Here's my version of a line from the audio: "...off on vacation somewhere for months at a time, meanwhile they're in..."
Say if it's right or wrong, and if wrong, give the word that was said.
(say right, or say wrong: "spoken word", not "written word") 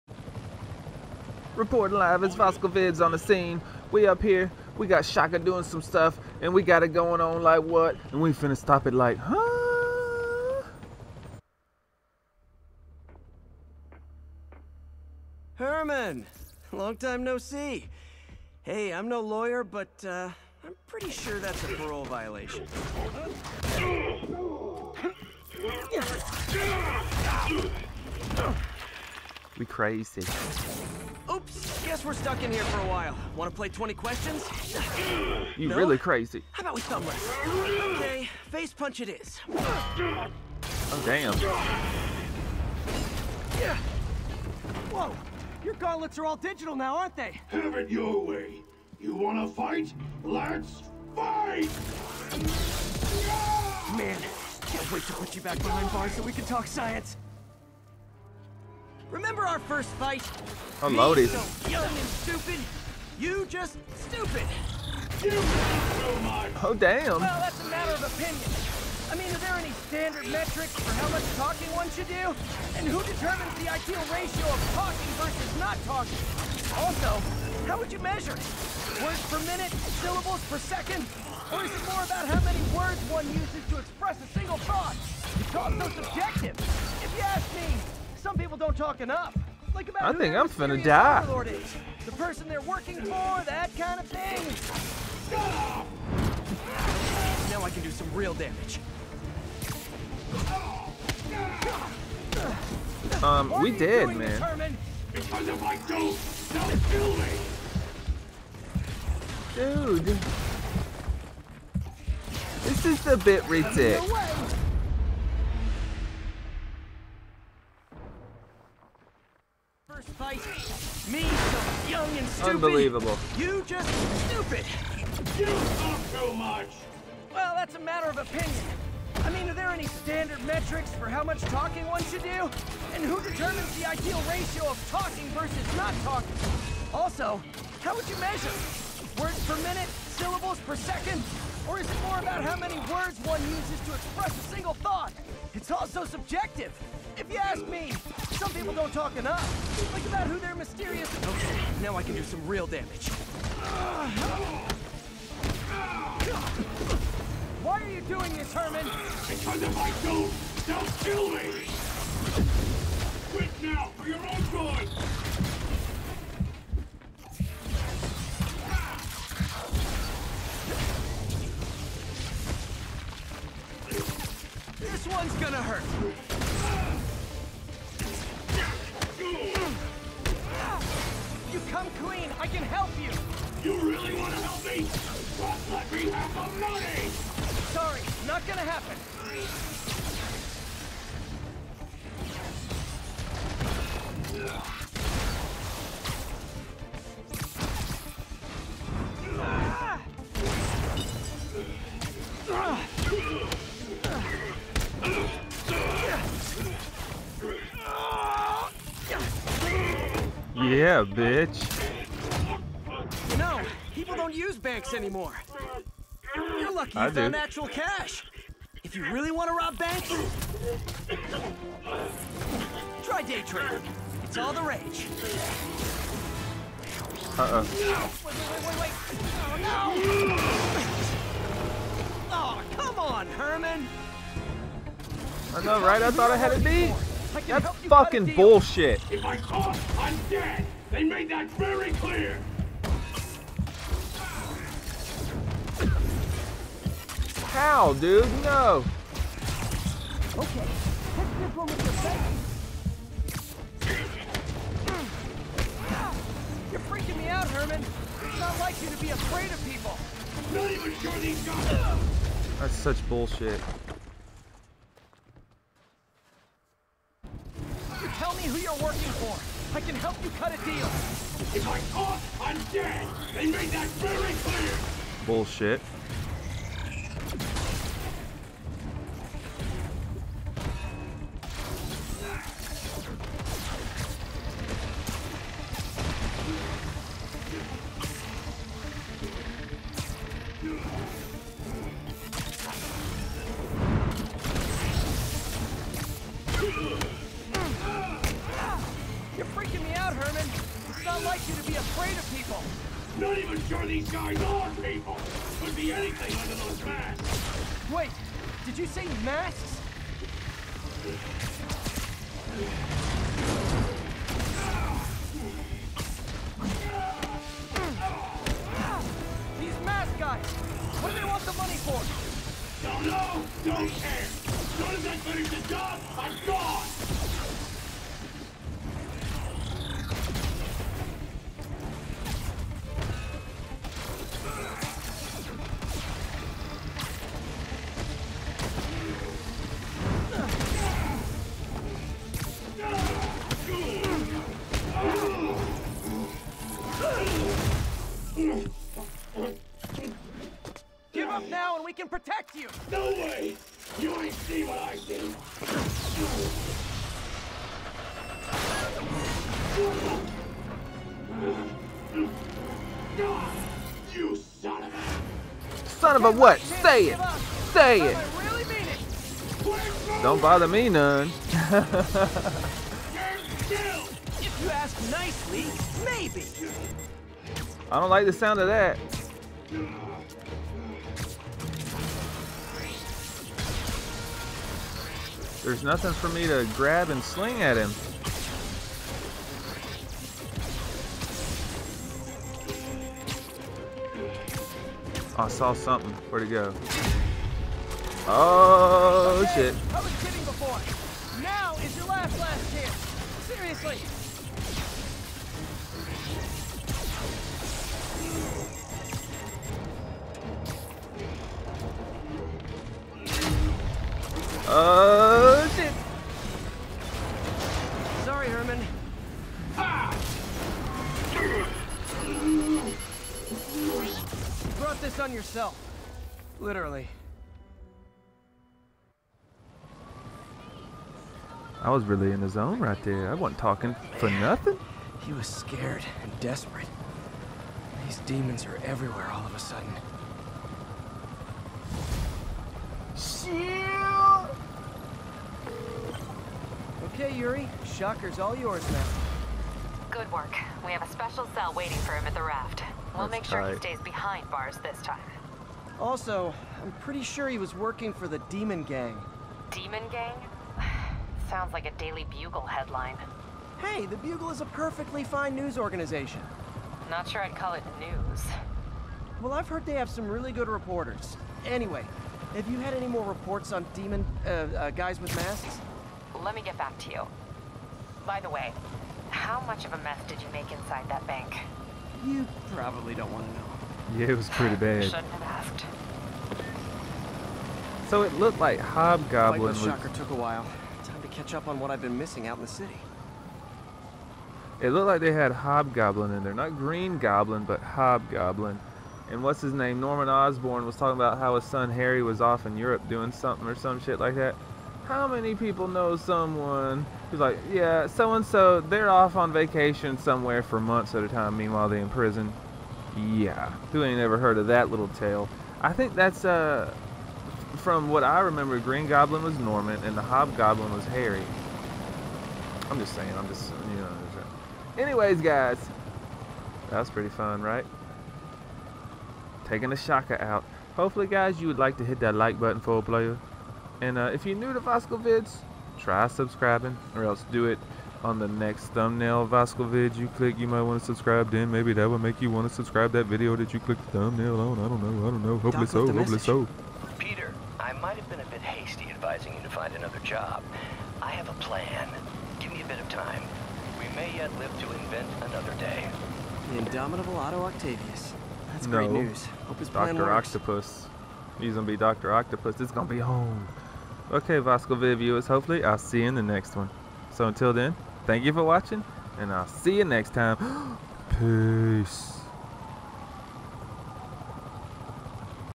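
right.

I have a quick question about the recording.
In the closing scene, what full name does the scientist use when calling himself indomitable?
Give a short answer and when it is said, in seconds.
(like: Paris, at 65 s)
Otto Octavius, at 557 s.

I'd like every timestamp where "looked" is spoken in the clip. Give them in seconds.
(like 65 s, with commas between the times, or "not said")
488 s, 494 s.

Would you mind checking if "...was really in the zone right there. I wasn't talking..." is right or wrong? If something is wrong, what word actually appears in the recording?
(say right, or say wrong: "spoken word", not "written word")
right.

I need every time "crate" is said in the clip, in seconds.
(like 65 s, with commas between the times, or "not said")
not said.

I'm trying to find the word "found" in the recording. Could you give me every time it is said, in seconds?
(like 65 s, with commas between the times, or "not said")
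217 s.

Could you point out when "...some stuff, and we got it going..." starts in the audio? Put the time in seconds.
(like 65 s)
5 s.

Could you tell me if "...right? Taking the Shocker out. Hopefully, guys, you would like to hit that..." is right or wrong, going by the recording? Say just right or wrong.
right.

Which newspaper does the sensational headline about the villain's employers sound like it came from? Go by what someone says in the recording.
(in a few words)
Daily Bugle.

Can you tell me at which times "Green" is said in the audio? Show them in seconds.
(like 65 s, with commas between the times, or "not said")
496 s, 518 s.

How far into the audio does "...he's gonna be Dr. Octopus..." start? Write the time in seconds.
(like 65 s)
561 s.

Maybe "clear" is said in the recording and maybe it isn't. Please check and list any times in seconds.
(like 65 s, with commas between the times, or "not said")
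241 s, 274 s.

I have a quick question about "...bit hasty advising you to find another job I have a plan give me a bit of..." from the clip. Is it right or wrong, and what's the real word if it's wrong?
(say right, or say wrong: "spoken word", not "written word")
right.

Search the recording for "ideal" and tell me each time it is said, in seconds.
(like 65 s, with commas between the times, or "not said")
73 s, 133 s.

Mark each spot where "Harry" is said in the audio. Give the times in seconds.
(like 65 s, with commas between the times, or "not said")
501 s, 521 s.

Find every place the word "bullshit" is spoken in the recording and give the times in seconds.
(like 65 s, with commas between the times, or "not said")
238 s, 263 s, 275 s.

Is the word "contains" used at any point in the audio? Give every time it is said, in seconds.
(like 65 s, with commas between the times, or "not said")
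not said.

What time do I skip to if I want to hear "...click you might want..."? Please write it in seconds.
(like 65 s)
540 s.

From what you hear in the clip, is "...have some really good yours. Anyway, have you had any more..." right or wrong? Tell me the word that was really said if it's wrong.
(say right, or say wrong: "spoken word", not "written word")
wrong: "reporters", not "yours".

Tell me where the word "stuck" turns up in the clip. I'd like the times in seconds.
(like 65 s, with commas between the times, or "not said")
32 s.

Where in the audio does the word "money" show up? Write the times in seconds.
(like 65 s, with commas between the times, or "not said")
186 s, 321 s.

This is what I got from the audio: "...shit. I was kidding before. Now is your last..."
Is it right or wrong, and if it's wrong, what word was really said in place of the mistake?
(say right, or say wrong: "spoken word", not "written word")
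right.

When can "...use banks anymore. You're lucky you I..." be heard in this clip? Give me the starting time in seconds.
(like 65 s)
214 s.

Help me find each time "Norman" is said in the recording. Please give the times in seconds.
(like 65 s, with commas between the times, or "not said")
500 s, 519 s.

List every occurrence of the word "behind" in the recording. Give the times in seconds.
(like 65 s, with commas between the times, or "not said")
55 s, 454 s.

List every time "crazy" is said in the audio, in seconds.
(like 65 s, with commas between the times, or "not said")
29 s, 35 s.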